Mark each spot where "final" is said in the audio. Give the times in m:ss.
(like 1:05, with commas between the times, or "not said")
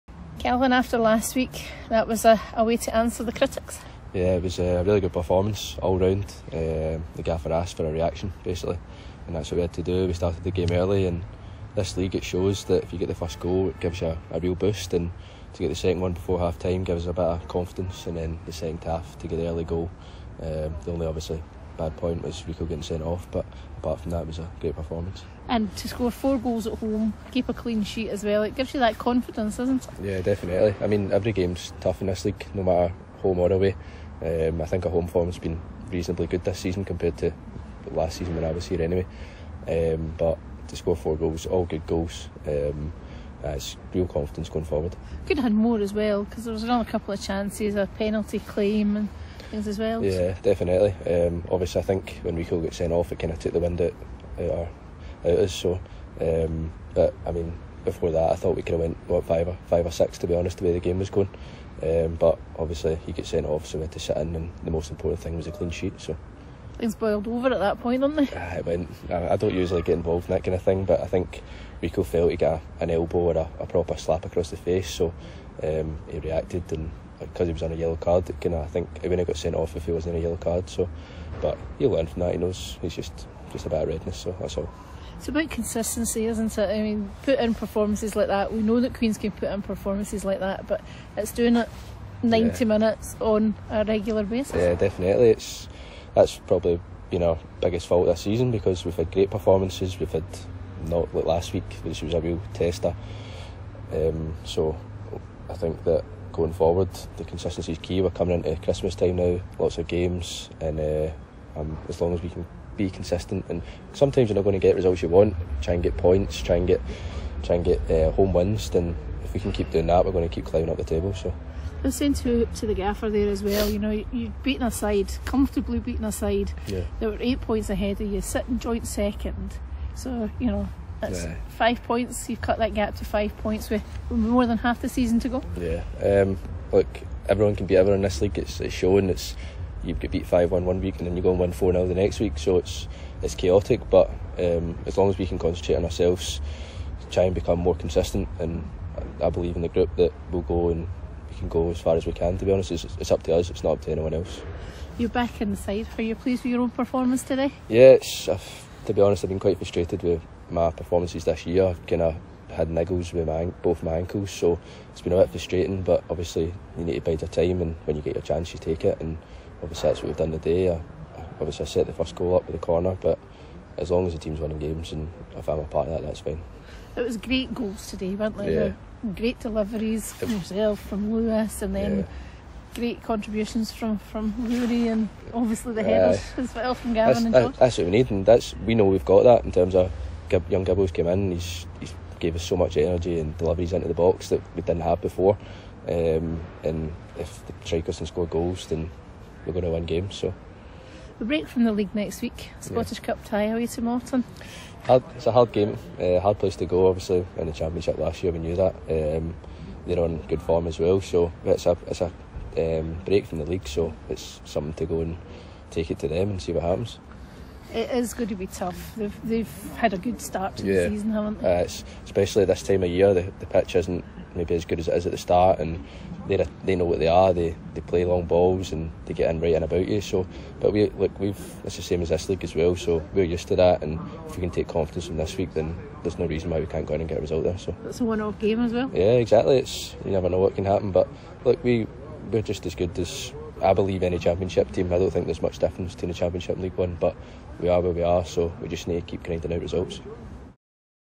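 not said.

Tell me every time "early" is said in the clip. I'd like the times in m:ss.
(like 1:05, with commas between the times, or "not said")
0:10, 0:19.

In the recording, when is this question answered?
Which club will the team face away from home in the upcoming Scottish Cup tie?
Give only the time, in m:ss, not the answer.
3:23.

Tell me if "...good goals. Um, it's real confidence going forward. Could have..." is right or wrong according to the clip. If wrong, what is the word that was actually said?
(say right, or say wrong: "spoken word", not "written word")
right.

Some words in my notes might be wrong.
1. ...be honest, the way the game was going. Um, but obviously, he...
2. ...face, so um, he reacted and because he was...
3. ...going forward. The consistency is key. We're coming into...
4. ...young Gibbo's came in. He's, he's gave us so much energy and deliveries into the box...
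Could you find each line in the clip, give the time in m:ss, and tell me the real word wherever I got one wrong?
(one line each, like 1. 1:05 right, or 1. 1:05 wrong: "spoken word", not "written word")
1. 1:00 right
2. 1:14 right
3. 1:46 right
4. 3:10 right.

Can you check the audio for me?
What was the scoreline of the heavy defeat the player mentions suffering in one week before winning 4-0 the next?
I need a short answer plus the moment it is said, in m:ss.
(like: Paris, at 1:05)
5-1, at 2:20.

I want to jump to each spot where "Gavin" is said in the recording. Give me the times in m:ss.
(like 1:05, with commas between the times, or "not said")
3:06.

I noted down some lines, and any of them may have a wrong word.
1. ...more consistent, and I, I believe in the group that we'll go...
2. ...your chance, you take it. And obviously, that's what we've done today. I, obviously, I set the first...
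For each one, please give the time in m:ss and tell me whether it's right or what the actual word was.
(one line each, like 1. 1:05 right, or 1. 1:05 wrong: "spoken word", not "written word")
1. 2:27 right
2. 2:48 right.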